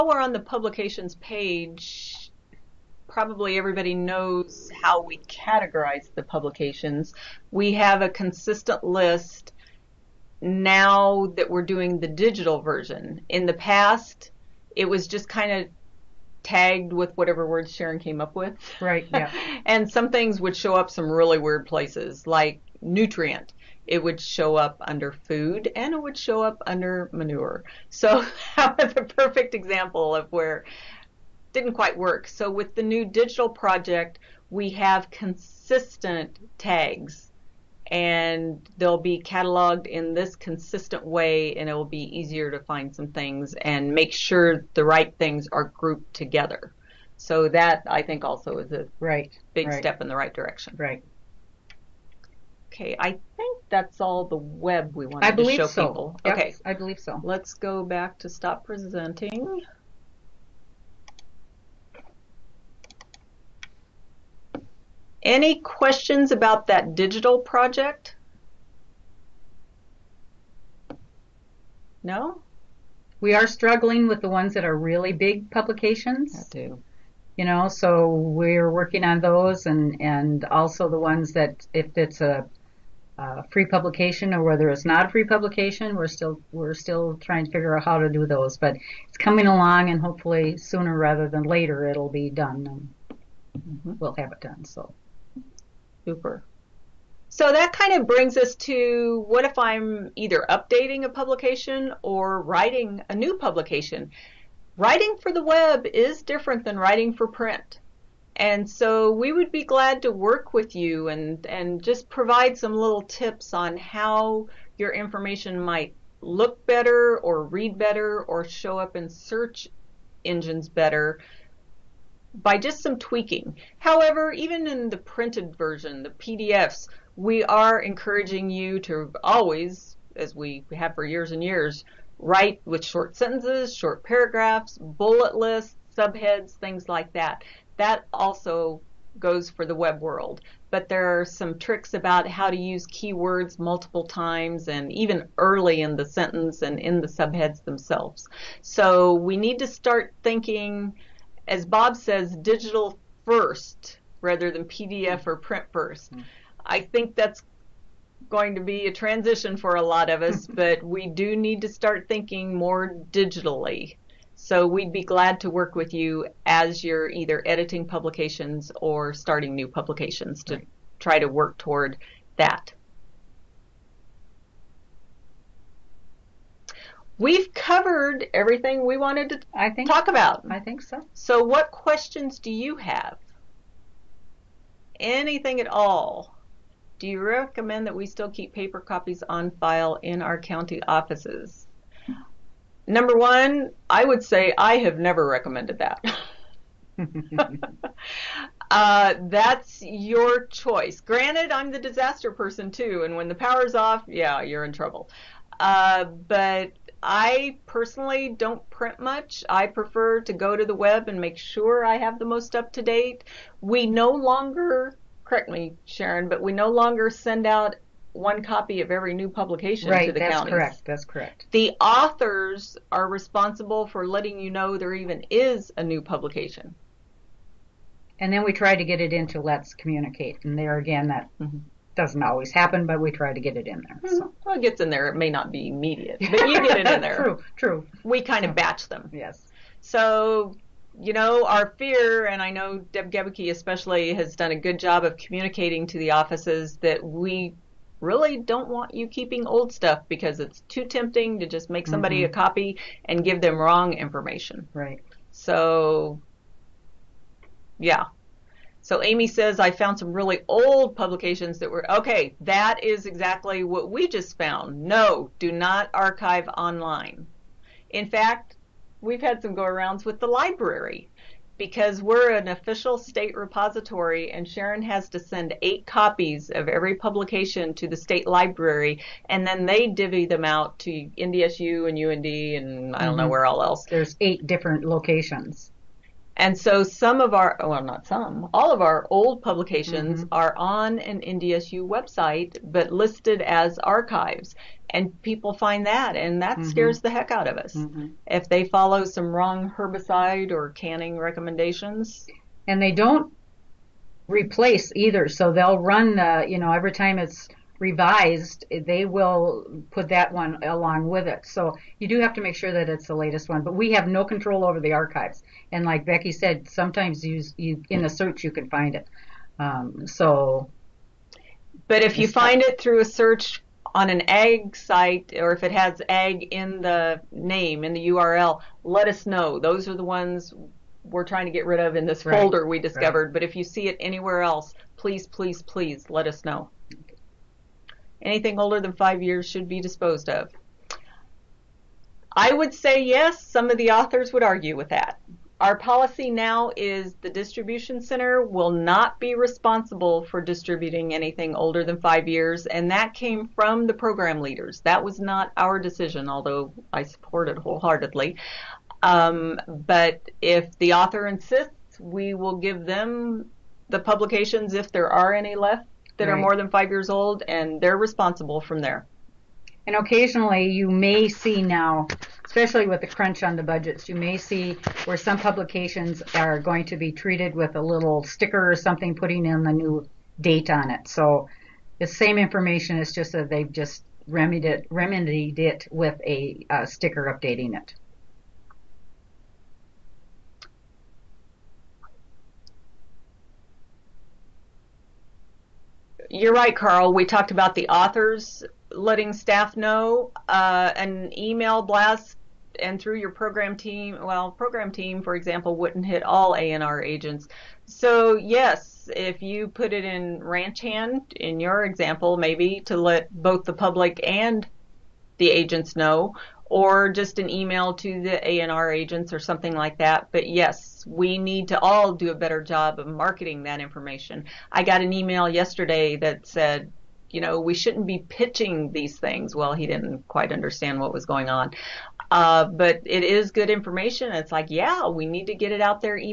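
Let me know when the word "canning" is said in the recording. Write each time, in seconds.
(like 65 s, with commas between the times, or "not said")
300 s.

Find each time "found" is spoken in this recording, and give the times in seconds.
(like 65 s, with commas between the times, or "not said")
259 s, 264 s.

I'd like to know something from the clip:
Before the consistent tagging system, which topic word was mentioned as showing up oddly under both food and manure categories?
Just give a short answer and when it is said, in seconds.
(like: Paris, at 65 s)
nutrient, at 22 s.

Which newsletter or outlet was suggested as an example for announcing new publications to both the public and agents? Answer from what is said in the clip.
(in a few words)
Ranch Hand.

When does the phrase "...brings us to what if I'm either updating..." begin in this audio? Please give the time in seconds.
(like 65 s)
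98 s.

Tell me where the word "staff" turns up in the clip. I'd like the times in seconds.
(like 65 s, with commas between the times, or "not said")
399 s.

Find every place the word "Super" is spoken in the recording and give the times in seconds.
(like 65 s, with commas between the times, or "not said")
96 s.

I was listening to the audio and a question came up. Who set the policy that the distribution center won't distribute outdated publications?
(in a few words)
the program leaders.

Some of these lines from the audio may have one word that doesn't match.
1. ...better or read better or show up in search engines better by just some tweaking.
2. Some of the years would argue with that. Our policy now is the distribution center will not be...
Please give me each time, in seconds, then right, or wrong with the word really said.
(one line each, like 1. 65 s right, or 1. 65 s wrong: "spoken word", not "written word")
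1. 116 s right
2. 343 s wrong: "authors", not "years".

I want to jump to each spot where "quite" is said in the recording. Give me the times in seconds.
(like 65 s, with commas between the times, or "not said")
31 s, 430 s.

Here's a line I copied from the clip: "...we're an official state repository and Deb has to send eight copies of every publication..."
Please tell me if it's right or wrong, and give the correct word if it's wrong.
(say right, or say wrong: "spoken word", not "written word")
wrong: "Sharon", not "Deb".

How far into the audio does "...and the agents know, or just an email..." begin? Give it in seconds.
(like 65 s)
414 s.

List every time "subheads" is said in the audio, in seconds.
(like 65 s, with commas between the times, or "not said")
135 s, 147 s.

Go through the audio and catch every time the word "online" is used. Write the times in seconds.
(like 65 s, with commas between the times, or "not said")
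266 s.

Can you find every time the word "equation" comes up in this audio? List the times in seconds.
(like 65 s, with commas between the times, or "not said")
not said.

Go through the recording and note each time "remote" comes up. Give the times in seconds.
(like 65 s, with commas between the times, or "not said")
not said.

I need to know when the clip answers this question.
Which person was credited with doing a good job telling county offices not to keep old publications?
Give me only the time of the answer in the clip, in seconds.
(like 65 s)
242 s.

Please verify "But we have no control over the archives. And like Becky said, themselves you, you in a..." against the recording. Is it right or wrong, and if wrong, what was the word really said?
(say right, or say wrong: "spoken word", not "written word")
wrong: "sometimes", not "themselves".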